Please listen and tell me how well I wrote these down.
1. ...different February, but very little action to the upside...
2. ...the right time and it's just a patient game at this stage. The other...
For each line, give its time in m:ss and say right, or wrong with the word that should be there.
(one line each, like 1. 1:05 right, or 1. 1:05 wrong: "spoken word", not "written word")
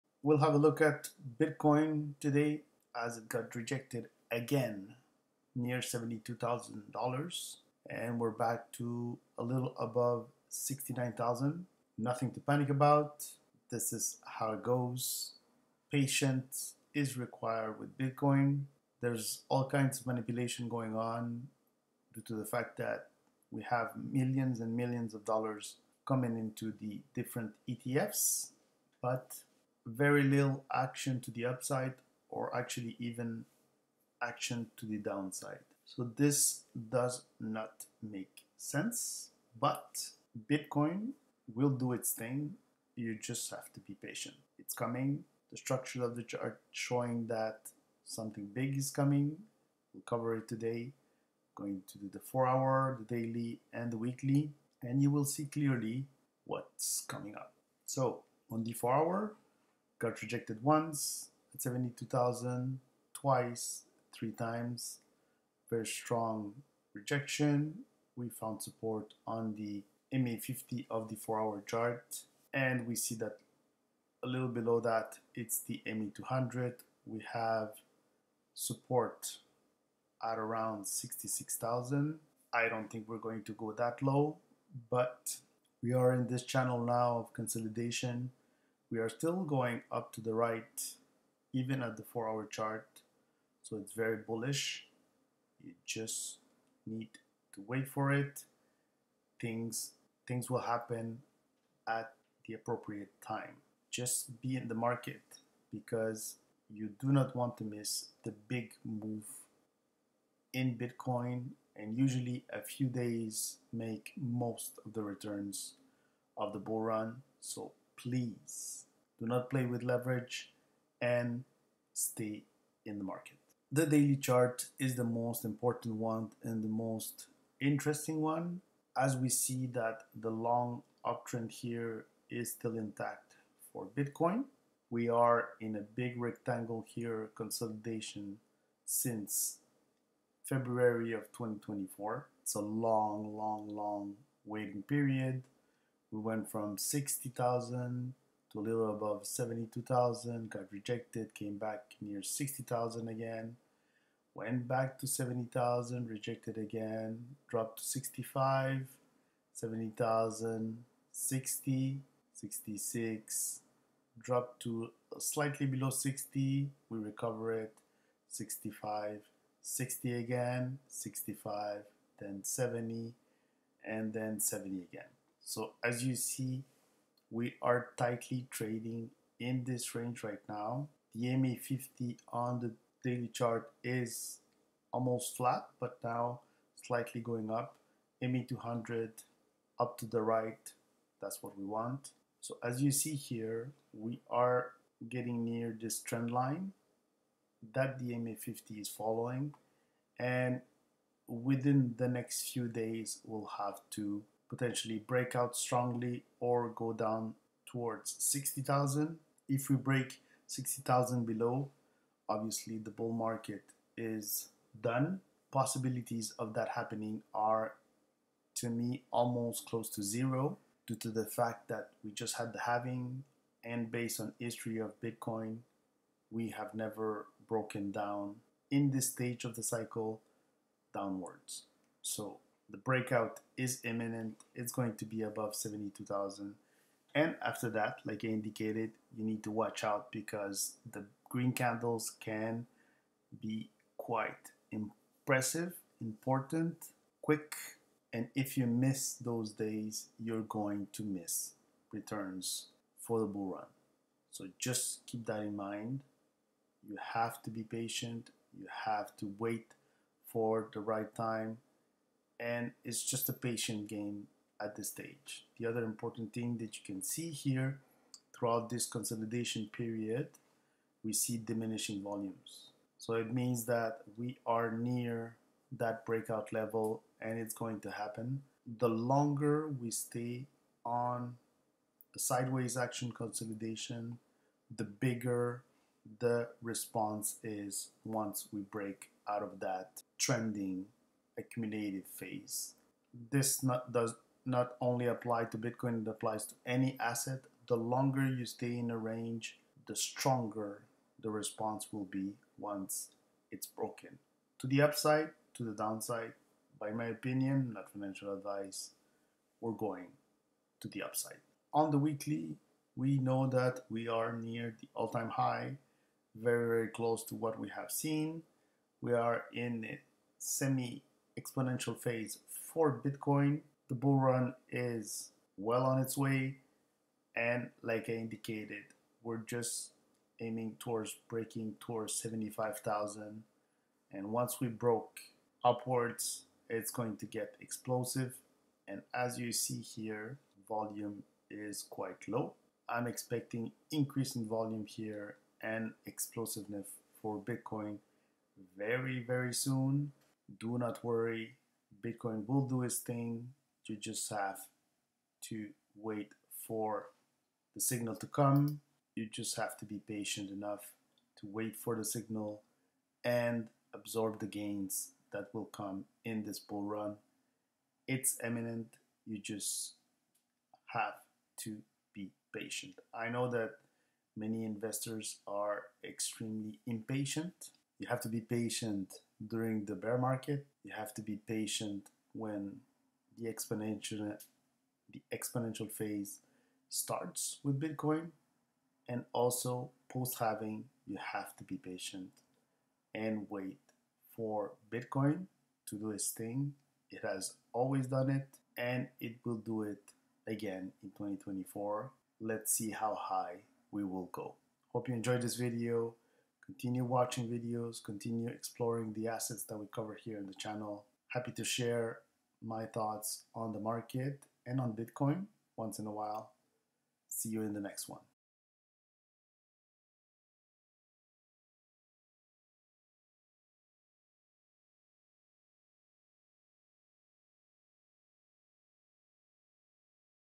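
1. 0:27 wrong: "ETFs", not "February"
2. 4:20 right.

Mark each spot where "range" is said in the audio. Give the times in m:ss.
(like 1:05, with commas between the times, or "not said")
2:59, 4:58.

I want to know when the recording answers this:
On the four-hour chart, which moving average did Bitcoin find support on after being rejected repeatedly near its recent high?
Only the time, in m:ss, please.
1:10.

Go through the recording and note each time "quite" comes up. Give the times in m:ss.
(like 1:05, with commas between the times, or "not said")
4:03, 5:41.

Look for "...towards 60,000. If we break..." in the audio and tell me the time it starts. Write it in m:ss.
3:27.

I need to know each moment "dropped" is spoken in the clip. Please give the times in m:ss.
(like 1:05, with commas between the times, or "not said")
2:37, 2:44.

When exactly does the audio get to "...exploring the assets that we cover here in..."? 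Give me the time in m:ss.
6:48.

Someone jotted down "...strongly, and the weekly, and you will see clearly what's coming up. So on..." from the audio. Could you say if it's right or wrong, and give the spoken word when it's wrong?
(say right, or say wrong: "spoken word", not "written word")
wrong: "daily", not "strongly".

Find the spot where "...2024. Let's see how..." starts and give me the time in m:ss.
6:41.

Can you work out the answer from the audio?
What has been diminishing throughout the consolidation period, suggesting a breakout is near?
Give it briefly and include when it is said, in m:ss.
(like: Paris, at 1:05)
volumes, at 4:31.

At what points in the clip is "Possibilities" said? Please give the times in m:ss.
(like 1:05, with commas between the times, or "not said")
3:35.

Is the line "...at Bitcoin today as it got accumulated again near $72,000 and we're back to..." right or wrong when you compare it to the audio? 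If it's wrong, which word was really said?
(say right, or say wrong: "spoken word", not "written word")
wrong: "rejected", not "accumulated".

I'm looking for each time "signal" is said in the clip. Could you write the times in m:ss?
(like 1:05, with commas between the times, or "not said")
5:57, 6:02.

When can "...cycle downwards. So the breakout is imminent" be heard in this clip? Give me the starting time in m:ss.
3:49.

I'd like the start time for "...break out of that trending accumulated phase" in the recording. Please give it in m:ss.
4:48.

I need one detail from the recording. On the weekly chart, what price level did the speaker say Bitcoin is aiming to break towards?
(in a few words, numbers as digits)
75,000.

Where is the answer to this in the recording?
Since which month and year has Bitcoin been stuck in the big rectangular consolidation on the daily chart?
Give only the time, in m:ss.
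2:20.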